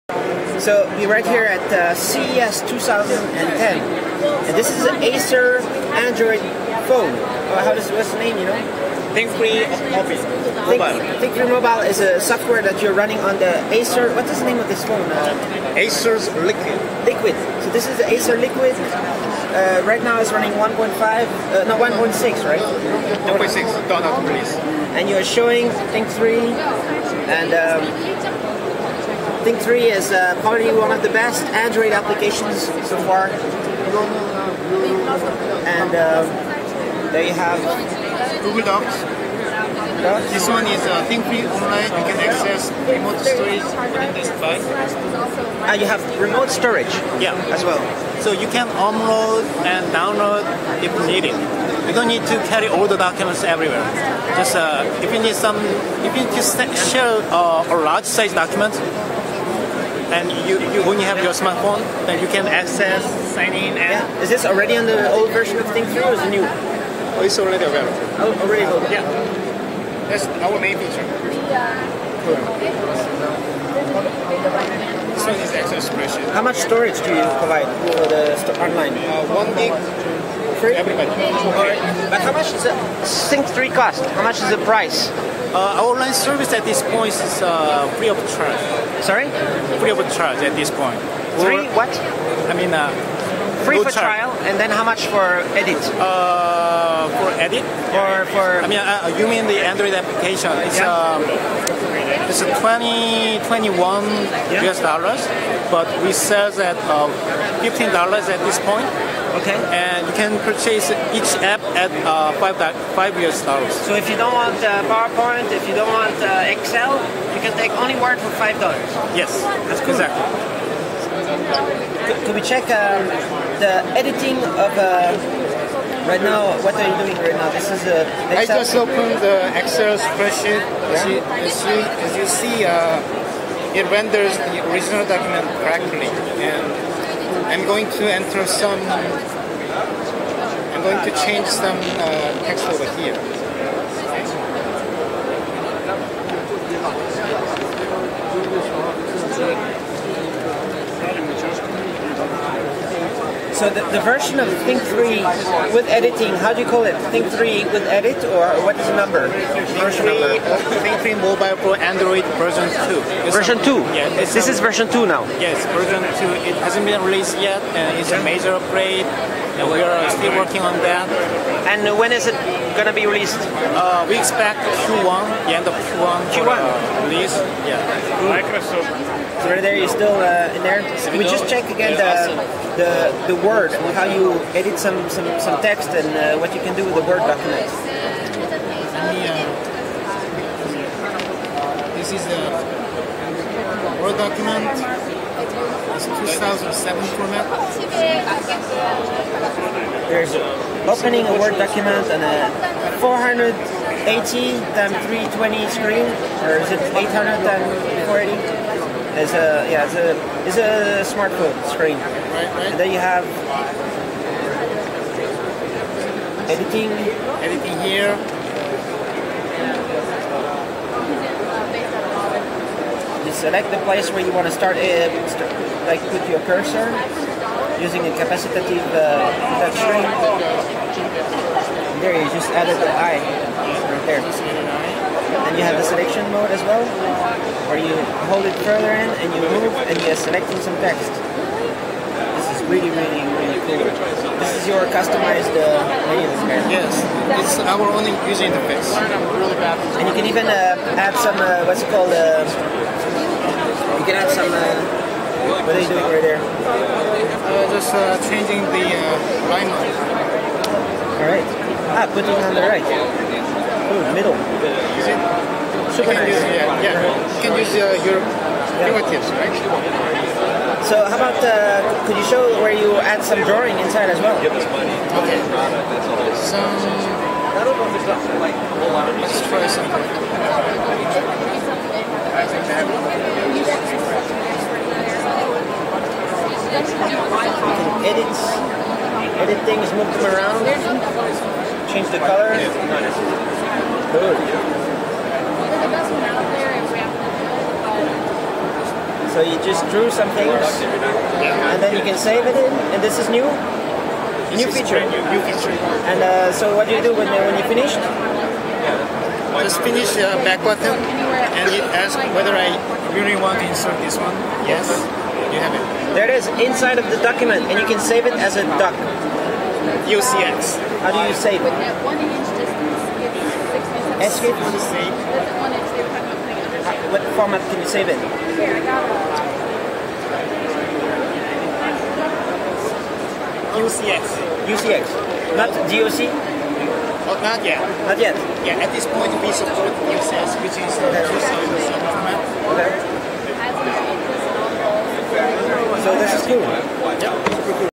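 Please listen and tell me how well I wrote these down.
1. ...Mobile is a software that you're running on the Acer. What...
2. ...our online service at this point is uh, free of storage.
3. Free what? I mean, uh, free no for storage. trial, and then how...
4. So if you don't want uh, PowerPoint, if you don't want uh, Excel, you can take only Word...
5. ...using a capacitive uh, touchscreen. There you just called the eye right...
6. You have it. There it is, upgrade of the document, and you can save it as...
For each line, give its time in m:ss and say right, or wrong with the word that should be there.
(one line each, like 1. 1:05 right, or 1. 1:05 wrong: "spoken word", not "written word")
1. 0:11 right
2. 1:25 wrong: "charge", not "storage"
3. 1:31 wrong: "charge", not "storage"
4. 1:53 right
5. 3:47 wrong: "added", not "called"
6. 5:15 wrong: "inside", not "upgrade".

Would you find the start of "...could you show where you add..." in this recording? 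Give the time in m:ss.
4:32.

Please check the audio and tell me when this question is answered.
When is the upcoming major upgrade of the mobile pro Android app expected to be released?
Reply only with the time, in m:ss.
2:55.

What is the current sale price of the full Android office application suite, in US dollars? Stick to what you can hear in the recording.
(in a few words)
$15.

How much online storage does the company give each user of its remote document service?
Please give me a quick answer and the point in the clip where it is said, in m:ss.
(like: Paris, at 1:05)
1 gig, at 1:19.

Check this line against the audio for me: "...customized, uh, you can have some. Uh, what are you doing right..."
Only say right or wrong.
wrong.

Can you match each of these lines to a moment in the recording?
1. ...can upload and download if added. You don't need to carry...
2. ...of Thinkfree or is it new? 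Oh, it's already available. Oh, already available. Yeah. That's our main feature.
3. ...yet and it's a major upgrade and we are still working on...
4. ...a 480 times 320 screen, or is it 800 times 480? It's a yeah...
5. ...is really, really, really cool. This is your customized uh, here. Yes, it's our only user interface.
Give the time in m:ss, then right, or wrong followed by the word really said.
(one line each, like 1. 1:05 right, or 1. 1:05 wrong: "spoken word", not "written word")
1. 0:48 wrong: "needed", not "added"
2. 1:05 right
3. 2:47 right
4. 3:22 right
5. 4:02 right.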